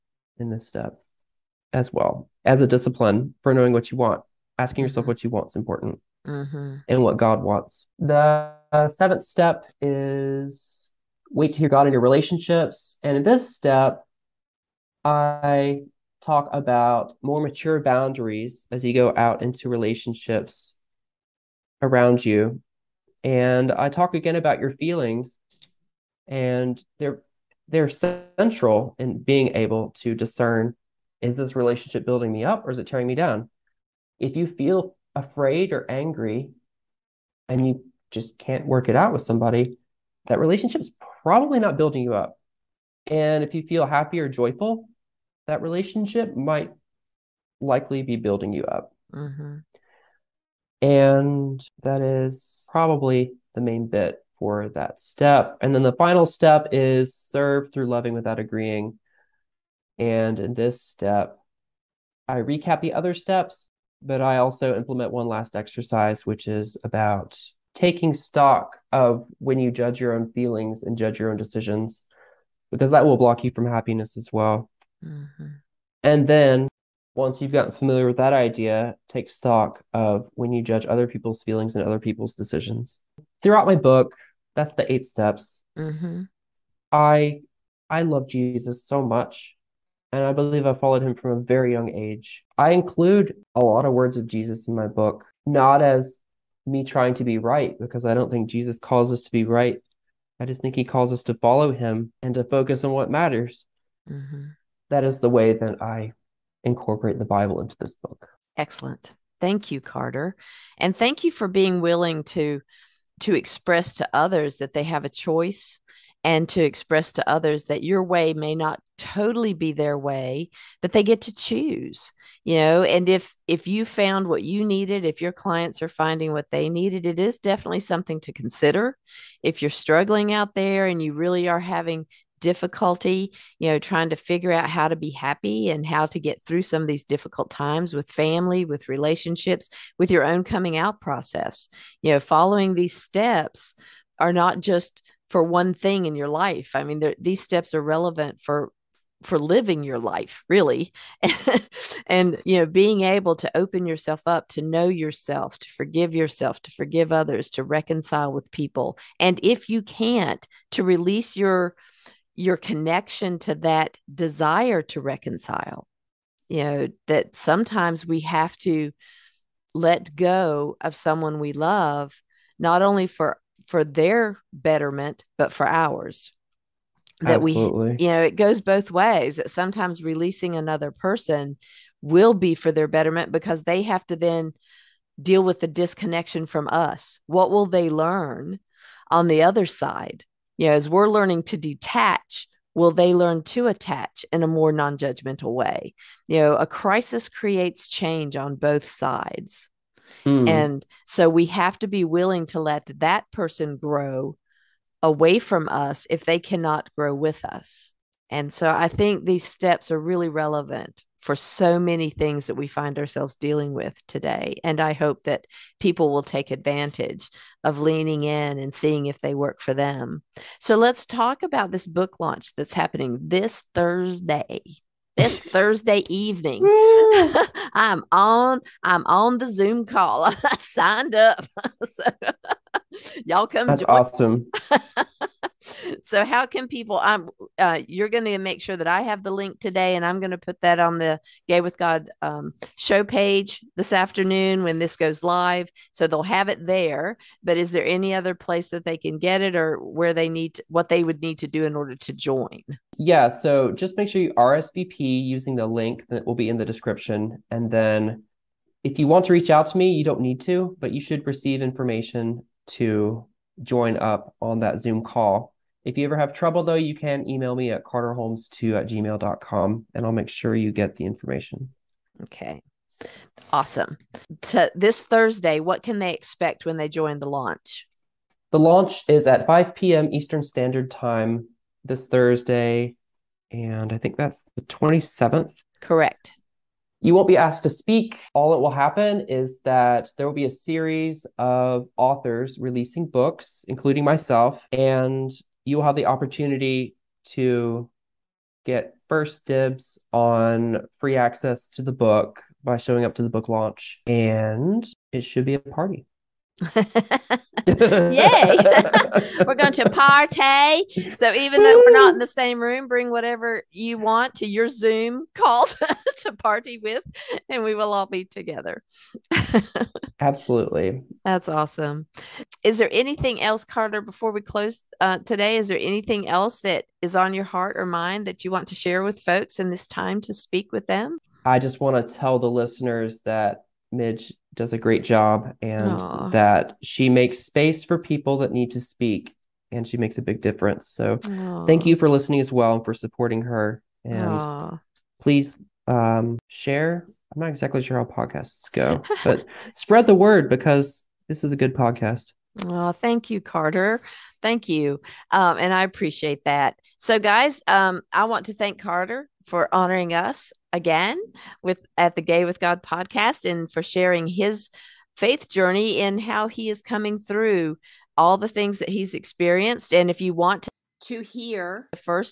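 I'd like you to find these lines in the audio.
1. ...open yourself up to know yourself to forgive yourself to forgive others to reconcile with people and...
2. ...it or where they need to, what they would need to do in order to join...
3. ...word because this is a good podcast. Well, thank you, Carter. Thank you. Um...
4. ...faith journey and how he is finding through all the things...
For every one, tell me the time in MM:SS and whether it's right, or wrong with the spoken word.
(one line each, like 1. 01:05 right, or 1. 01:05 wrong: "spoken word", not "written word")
1. 02:33 right
2. 04:09 right
3. 05:50 right
4. 06:05 wrong: "coming", not "finding".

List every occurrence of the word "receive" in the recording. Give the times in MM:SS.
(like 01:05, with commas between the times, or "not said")
04:21.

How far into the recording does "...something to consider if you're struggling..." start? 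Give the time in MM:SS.
02:07.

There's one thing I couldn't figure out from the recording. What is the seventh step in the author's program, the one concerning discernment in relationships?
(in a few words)
Wait to hear God in your relationships.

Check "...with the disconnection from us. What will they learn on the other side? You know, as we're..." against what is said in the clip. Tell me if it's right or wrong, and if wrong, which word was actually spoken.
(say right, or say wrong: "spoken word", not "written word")
right.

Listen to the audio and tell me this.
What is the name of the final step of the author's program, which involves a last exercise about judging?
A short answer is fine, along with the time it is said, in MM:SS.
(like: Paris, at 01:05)
Serve through loving without agreeing, at 00:57.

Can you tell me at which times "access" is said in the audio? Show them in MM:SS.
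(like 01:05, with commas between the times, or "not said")
05:01.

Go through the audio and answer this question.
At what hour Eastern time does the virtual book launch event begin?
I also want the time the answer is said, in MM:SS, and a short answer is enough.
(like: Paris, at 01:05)
5 p.m., at 04:39.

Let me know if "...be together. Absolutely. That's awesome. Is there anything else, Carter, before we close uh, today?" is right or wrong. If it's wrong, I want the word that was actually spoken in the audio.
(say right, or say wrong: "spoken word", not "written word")
right.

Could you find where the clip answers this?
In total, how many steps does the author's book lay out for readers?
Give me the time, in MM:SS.
01:24.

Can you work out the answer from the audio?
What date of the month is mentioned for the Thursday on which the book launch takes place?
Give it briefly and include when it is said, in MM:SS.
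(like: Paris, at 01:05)
27th, at 04:44.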